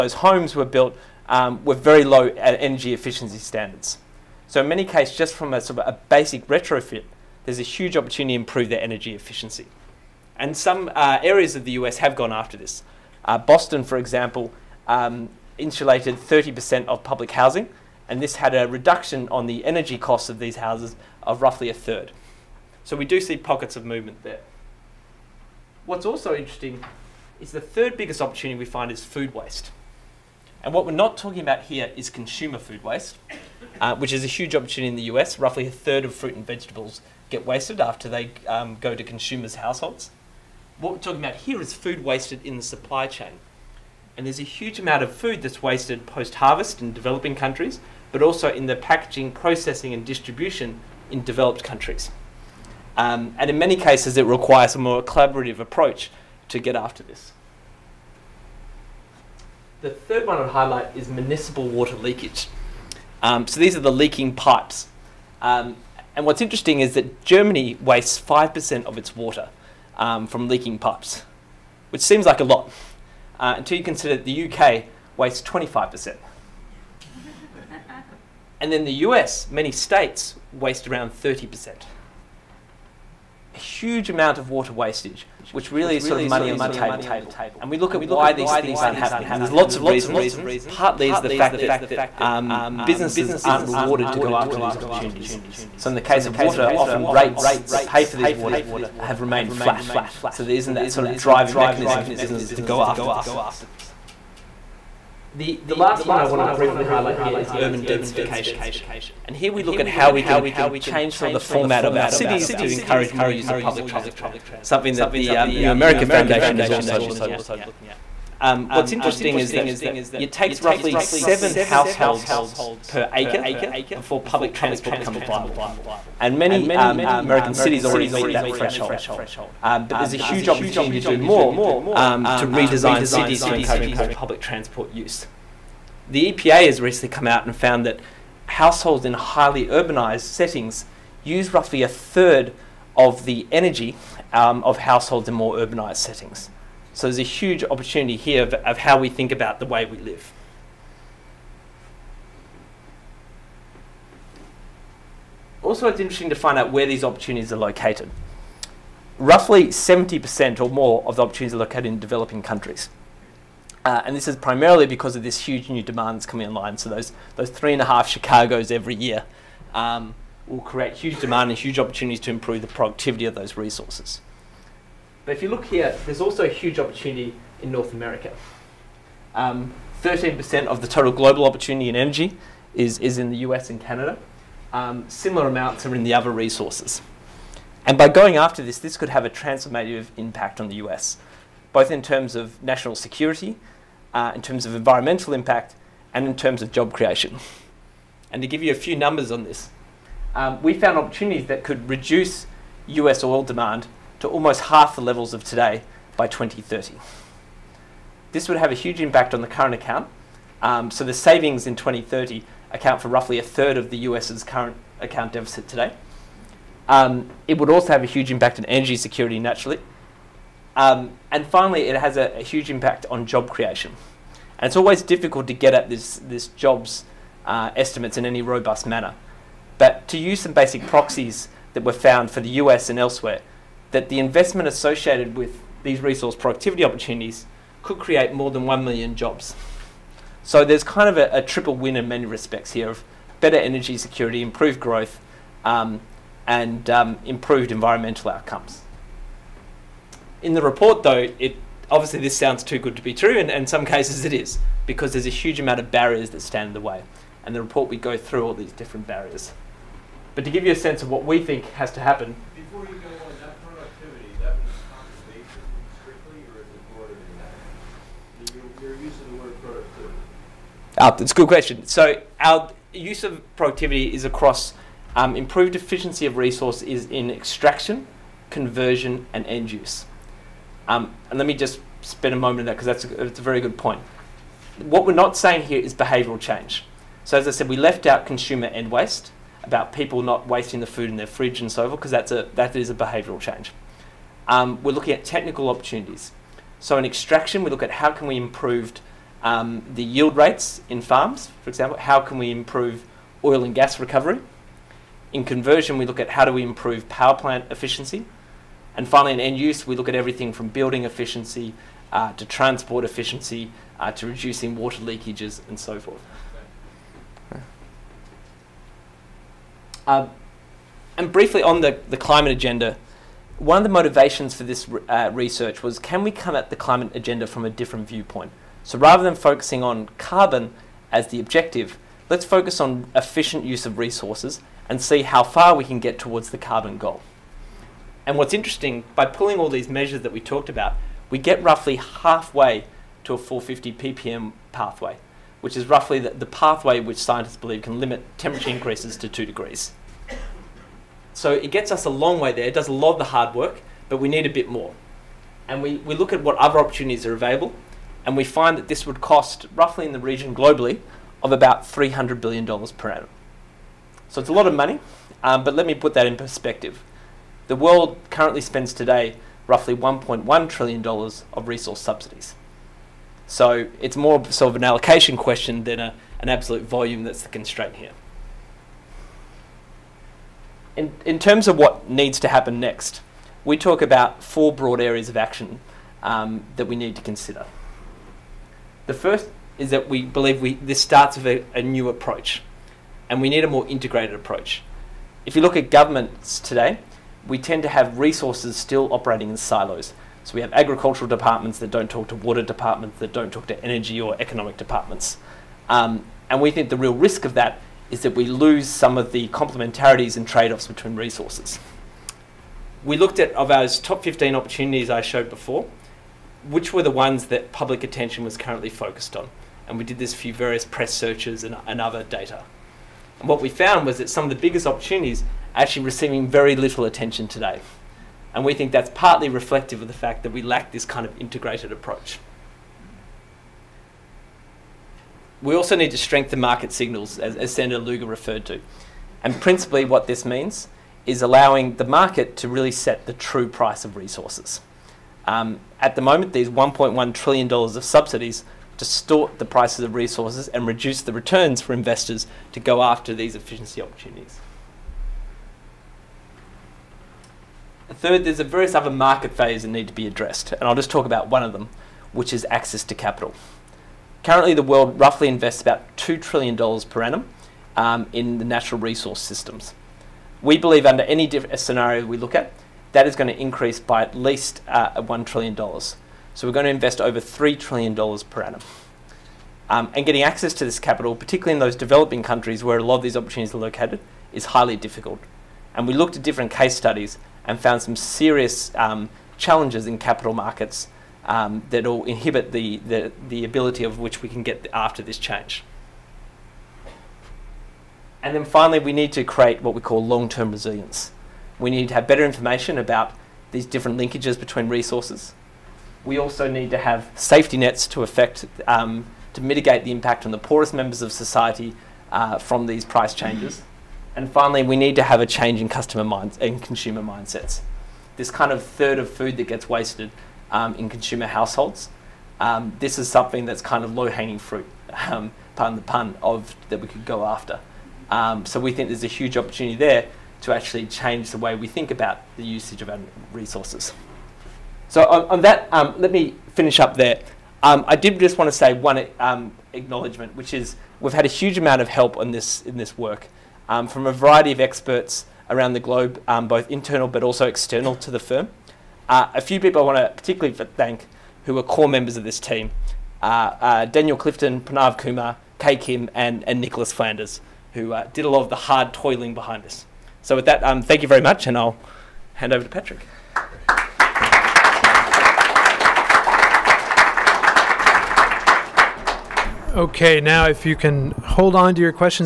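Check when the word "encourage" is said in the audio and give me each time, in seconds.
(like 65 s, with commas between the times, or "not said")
112 s, 133 s.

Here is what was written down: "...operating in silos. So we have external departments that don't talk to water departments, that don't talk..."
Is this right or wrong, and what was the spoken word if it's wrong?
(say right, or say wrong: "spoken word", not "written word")
wrong: "agricultural", not "external".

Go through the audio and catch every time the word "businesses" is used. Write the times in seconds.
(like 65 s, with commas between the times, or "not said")
92 s, 102 s.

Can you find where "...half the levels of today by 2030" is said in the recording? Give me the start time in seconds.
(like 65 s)
204 s.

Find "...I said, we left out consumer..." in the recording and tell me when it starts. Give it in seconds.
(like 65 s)
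287 s.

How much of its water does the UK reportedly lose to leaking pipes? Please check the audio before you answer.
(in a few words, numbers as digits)
25%.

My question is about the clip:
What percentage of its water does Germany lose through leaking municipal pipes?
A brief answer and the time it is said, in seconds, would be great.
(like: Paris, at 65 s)
5%, at 68 s.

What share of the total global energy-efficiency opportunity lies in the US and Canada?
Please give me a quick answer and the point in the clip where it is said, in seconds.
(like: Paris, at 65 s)
13%, at 179 s.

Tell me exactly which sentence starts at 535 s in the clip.
So on, on that, um, let me finish up there.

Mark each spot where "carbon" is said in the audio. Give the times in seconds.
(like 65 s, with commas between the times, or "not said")
330 s, 336 s.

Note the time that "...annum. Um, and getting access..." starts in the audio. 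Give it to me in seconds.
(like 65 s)
478 s.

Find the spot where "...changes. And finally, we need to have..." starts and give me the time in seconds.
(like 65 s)
513 s.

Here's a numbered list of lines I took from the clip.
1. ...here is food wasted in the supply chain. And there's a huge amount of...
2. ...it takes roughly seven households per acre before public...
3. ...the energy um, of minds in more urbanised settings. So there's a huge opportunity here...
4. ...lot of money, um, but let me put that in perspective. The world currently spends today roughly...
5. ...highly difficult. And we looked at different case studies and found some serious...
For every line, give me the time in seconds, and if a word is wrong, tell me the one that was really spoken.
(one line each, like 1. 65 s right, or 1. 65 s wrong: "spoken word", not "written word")
1. 41 s right
2. 120 s right
3. 143 s wrong: "households", not "minds"
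4. 364 s right
5. 484 s right.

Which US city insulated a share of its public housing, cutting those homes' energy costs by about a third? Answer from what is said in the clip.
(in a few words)
Boston.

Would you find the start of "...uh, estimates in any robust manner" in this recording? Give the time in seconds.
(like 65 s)
227 s.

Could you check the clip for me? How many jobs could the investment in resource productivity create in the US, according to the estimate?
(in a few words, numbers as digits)
More than 1 million.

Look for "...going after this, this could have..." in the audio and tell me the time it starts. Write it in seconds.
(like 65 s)
188 s.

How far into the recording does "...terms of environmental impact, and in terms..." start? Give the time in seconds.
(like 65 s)
194 s.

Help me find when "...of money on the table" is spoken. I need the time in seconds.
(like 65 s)
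86 s.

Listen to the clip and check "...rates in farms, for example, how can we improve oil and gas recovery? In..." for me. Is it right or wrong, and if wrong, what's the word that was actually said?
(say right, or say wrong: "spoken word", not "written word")
right.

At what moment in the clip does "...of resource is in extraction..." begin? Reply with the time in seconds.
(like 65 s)
276 s.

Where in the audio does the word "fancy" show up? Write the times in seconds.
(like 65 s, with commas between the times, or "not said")
not said.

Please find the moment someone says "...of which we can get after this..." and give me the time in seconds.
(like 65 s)
494 s.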